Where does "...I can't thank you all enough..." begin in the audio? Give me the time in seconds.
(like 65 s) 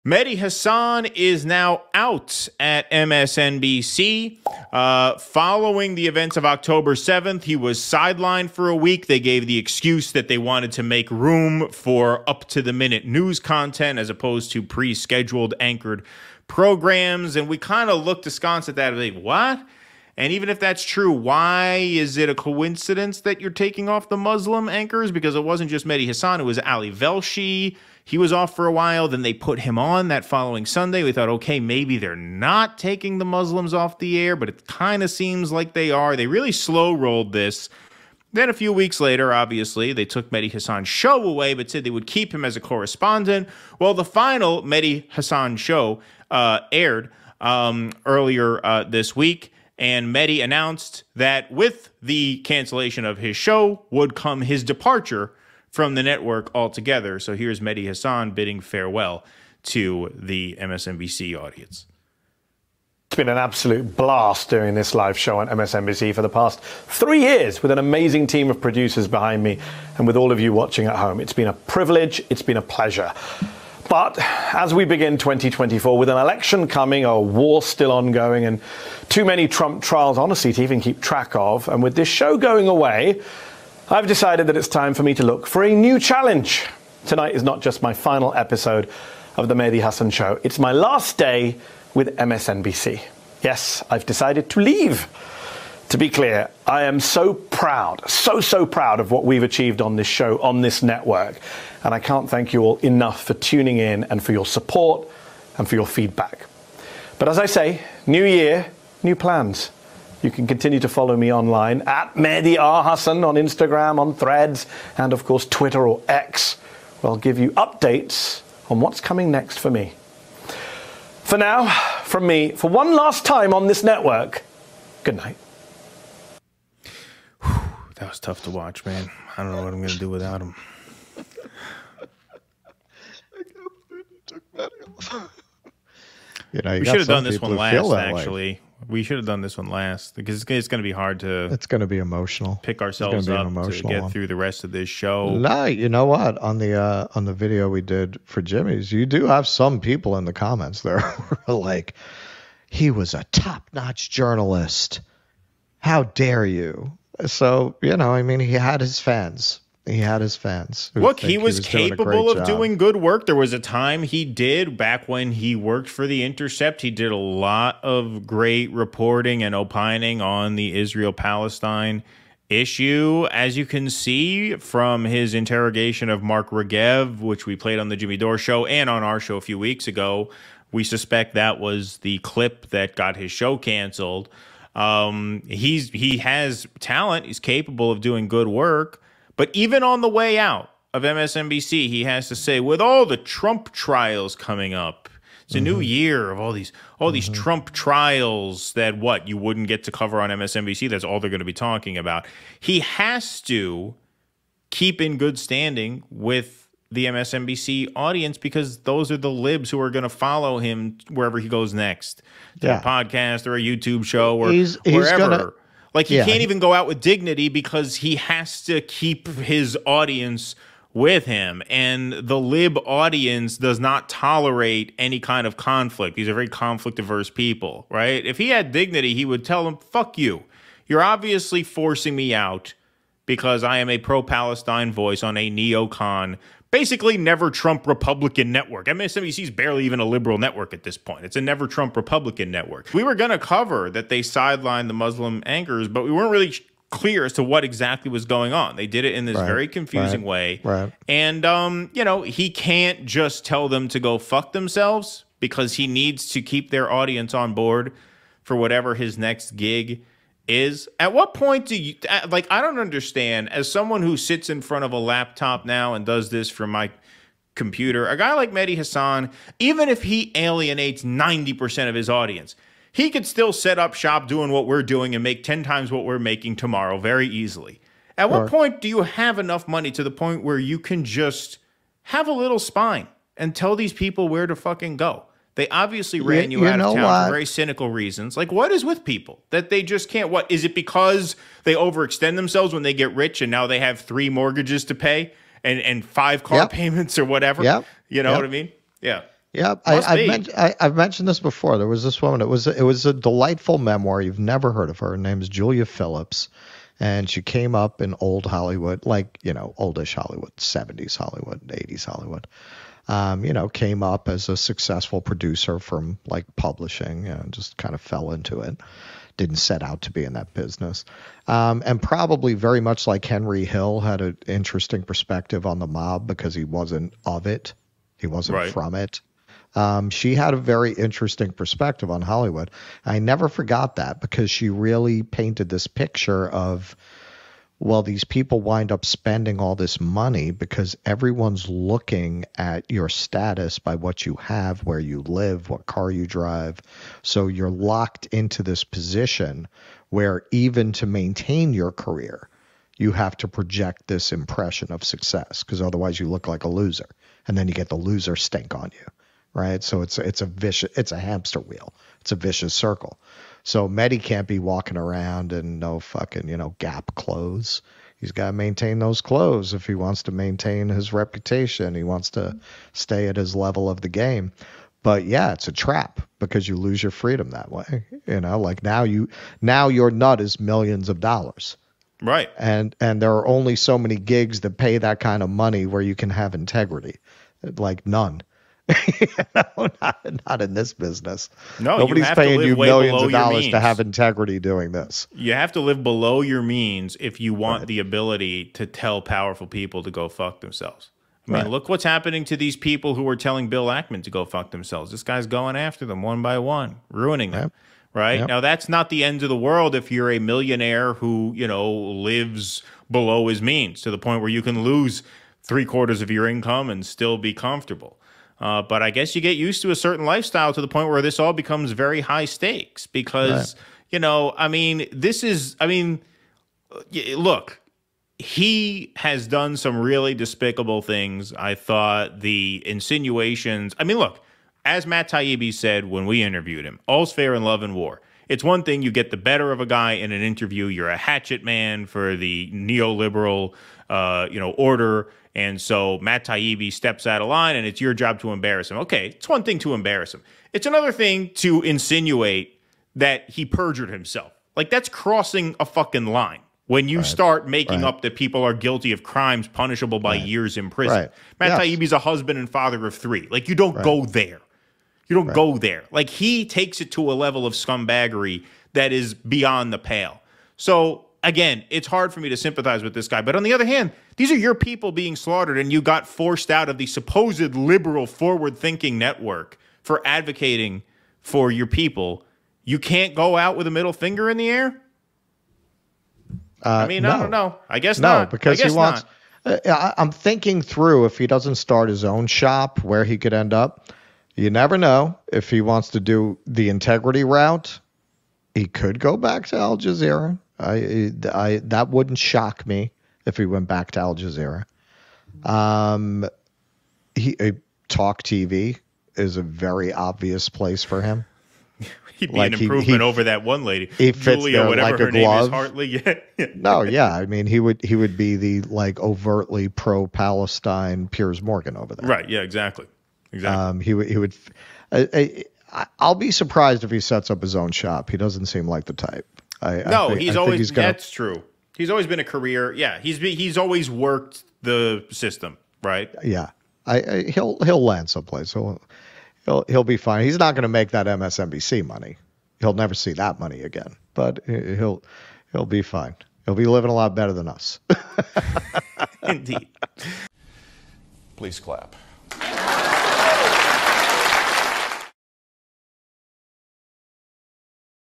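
101 s.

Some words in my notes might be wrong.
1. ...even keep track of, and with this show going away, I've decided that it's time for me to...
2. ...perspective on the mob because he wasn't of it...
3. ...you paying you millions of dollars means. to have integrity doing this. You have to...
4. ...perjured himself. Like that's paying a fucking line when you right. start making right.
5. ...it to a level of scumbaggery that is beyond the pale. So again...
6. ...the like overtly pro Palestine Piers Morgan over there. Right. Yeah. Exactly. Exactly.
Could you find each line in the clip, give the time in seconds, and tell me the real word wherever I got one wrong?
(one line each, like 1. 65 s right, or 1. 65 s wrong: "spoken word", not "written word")
1. 80 s right
2. 325 s right
3. 392 s right
4. 453 s wrong: "crossing", not "paying"
5. 467 s right
6. 518 s right.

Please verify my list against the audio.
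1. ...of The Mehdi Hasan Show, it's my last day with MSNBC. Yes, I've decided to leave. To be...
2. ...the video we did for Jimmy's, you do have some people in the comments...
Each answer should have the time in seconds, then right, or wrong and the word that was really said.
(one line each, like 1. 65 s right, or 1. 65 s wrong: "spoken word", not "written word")
1. 89 s right
2. 147 s right.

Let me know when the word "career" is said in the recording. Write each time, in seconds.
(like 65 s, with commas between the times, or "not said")
351 s, 532 s.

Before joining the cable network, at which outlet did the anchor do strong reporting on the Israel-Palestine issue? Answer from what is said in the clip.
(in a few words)
The Intercept.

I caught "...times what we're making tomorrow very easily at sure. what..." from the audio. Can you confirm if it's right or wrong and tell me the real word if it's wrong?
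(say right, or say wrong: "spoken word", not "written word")
right.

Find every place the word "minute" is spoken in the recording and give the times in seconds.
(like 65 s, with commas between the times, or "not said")
12 s.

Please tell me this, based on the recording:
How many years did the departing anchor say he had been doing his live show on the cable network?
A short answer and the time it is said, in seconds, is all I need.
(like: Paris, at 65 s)
3, at 66 s.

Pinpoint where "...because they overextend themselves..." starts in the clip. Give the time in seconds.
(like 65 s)
290 s.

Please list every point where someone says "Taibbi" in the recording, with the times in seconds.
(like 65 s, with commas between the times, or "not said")
435 s, 446 s, 461 s.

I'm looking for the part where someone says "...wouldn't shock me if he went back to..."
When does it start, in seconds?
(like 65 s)
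502 s.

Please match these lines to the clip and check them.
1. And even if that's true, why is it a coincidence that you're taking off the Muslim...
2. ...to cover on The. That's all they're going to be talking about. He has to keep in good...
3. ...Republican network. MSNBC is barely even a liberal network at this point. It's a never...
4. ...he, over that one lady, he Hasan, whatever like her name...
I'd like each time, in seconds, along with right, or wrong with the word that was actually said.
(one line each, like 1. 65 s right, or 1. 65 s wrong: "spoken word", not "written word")
1. 20 s right
2. 199 s wrong: "MSNBC", not "The"
3. 237 s right
4. 513 s wrong: "Julia", not "Hasan".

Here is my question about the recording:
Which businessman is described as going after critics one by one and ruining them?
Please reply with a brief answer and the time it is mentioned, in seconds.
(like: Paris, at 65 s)
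Bill Ackman, at 403 s.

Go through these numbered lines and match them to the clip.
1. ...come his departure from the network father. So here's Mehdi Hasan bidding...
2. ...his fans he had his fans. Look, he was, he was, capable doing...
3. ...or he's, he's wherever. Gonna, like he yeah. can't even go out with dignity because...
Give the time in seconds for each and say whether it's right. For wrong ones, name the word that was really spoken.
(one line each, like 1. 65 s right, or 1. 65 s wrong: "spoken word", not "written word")
1. 54 s wrong: "altogether", not "father"
2. 158 s right
3. 214 s right.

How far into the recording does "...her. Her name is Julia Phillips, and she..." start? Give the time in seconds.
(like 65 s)
304 s.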